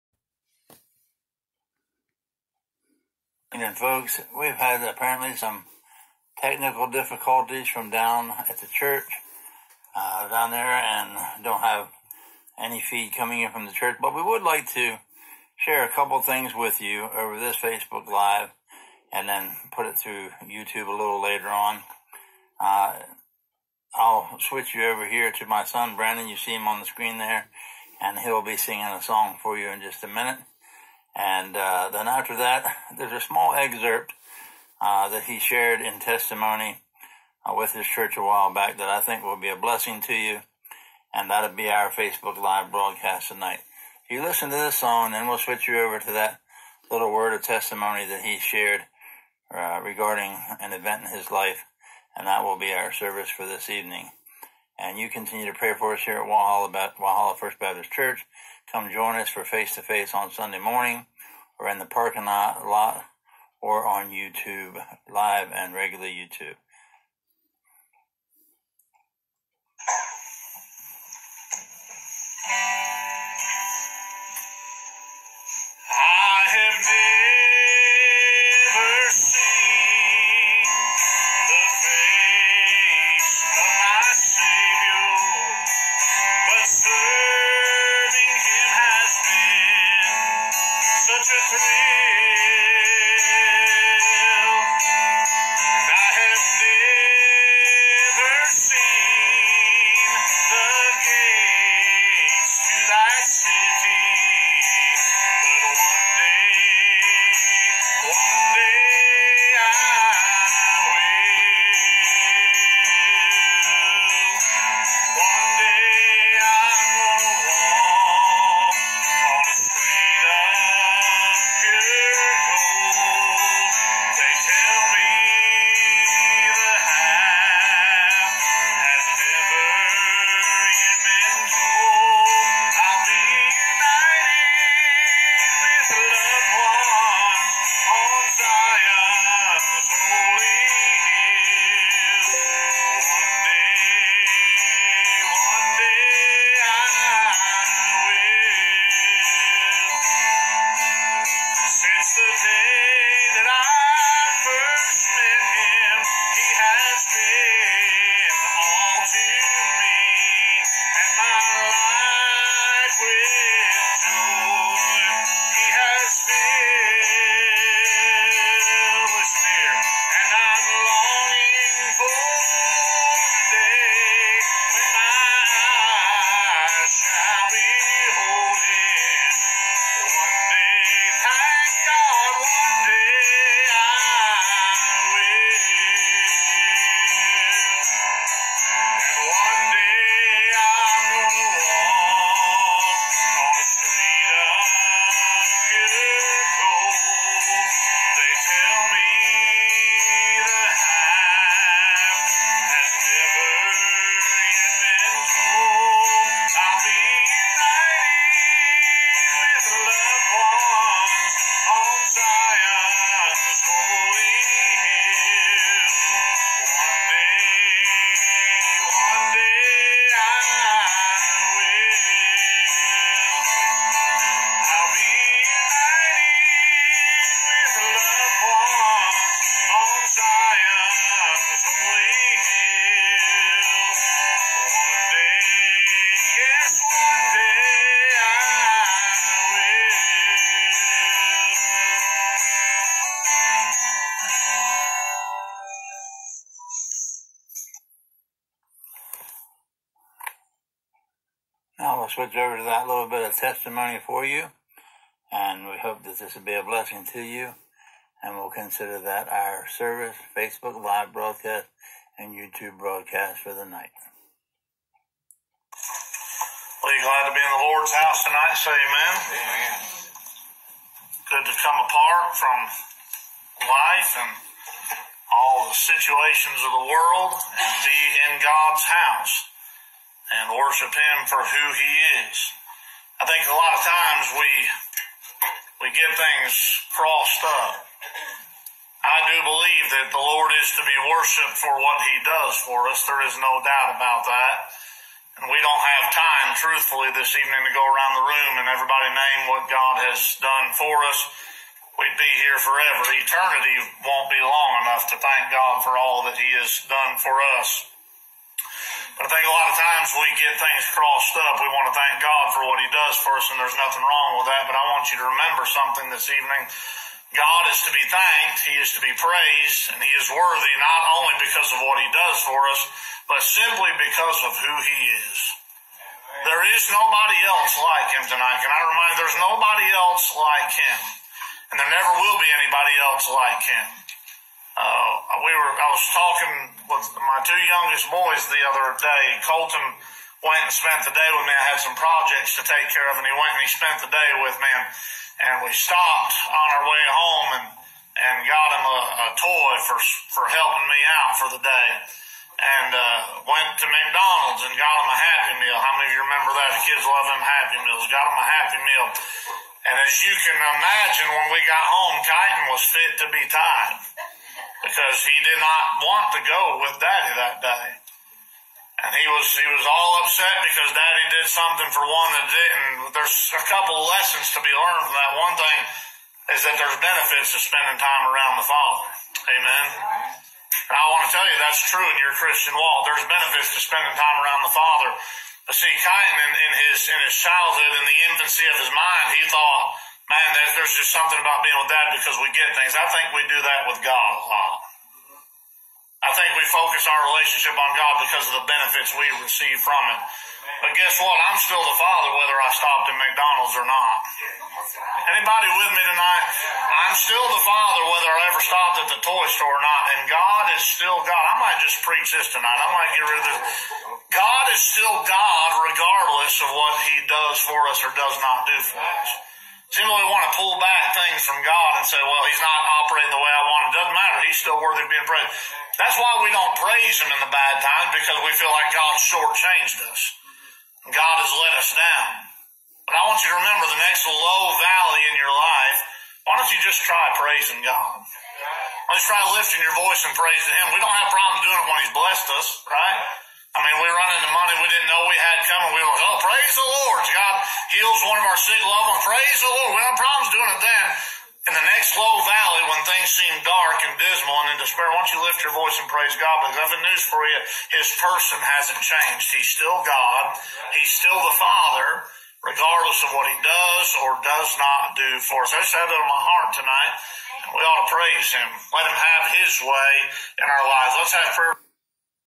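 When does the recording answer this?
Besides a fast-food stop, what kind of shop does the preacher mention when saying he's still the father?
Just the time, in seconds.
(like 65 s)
409 s.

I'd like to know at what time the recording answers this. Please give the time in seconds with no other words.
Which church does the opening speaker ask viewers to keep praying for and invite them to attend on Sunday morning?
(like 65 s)
56 s.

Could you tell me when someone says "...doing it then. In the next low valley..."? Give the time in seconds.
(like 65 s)
450 s.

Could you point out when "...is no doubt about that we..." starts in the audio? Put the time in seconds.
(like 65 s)
293 s.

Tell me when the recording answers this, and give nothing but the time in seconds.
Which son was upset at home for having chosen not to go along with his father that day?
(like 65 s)
362 s.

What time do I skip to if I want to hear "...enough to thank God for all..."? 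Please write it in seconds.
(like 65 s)
304 s.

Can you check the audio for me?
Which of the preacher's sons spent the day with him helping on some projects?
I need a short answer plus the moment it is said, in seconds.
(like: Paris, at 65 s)
Colton, at 339 s.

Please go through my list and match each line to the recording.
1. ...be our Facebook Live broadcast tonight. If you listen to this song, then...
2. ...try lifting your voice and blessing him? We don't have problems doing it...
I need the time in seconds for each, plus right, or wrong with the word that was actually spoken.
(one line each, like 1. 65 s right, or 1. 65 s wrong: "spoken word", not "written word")
1. 41 s right
2. 439 s wrong: "praising", not "blessing".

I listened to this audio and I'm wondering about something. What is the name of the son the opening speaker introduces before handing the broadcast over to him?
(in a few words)
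Brandon.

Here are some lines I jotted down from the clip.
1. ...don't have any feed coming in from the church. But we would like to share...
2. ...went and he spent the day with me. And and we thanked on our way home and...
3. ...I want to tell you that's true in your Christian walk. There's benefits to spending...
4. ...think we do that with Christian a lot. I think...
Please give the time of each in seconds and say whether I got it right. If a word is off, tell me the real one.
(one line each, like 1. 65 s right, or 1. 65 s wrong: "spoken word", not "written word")
1. 11 s right
2. 343 s wrong: "stopped", not "thanked"
3. 380 s right
4. 393 s wrong: "God", not "Christian".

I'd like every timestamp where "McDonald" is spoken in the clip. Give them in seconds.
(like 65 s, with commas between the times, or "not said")
353 s, 403 s.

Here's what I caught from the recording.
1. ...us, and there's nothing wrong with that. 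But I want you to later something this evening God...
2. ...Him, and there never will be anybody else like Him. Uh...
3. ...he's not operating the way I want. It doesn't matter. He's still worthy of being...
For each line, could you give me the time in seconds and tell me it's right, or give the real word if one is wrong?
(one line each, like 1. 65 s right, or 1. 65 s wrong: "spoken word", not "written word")
1. 313 s wrong: "remember", not "later"
2. 330 s right
3. 422 s right.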